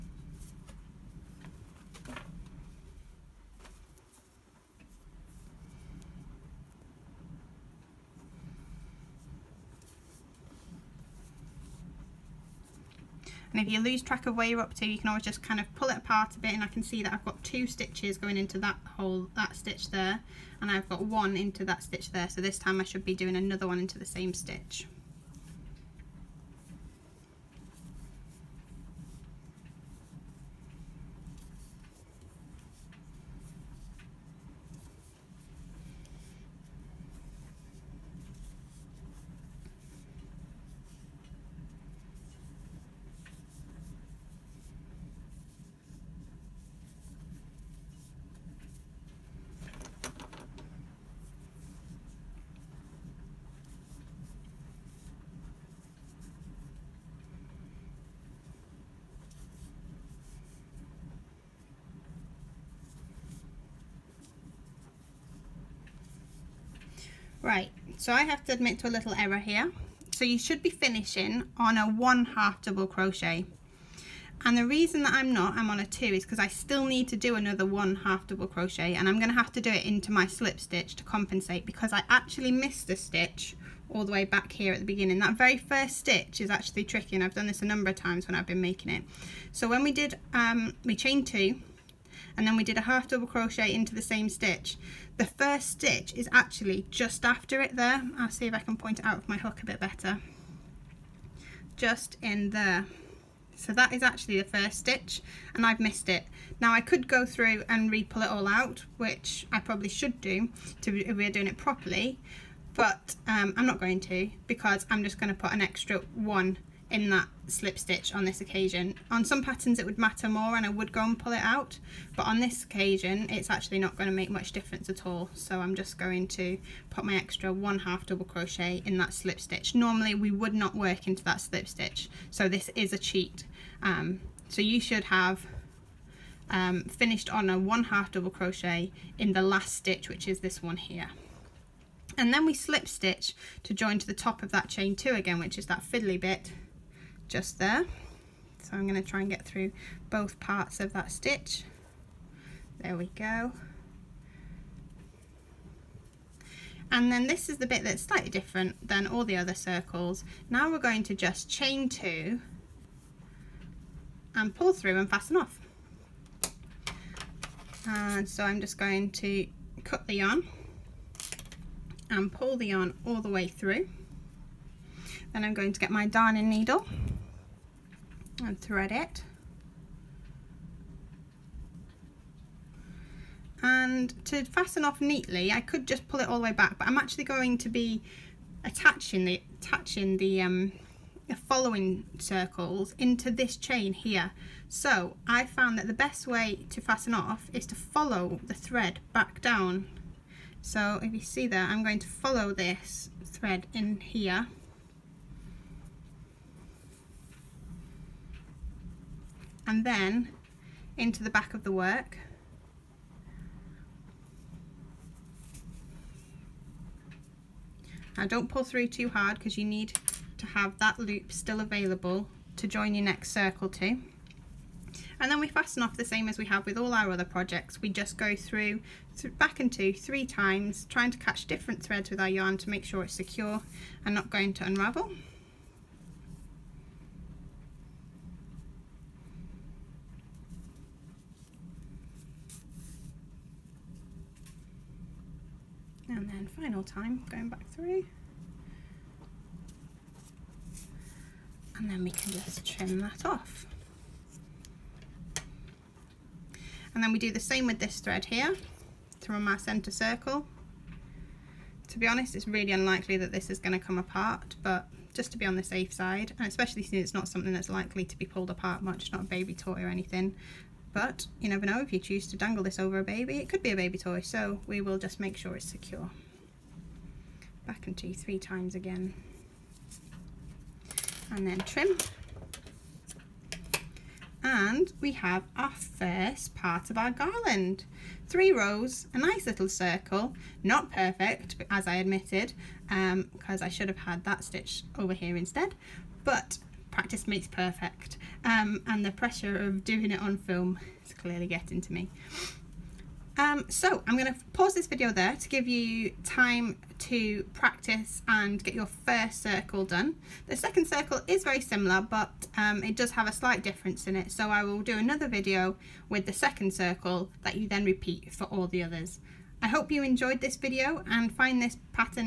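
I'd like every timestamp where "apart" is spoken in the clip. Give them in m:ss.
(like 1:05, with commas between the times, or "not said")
0:15, 4:23, 4:28.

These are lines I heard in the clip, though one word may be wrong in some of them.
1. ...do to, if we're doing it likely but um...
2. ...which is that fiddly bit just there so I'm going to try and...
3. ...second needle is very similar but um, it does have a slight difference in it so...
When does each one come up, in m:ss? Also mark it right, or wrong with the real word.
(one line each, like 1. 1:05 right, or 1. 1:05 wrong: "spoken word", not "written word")
1. 1:50 wrong: "properly", not "likely"
2. 2:25 right
3. 5:10 wrong: "circle", not "needle".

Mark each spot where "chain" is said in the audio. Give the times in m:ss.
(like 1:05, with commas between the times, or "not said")
1:30, 2:24, 2:41, 3:13.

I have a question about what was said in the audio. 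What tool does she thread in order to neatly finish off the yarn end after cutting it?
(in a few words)
darning needle.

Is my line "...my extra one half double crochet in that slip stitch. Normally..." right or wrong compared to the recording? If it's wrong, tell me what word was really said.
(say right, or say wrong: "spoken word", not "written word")
right.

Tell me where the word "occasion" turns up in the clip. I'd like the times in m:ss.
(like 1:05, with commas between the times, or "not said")
1:58, 2:02.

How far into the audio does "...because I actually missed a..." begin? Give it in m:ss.
1:21.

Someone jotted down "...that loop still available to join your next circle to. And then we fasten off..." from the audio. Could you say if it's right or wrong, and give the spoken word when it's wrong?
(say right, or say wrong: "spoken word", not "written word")
right.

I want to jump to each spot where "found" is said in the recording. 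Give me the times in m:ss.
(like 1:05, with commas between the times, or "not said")
3:15.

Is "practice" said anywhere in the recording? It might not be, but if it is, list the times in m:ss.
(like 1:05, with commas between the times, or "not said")
4:56, 5:07.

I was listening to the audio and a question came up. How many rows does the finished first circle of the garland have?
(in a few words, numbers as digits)
3.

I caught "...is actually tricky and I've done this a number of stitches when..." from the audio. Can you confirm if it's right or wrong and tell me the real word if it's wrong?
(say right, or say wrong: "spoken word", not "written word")
wrong: "times", not "stitches".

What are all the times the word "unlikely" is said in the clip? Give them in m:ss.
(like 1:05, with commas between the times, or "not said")
4:22.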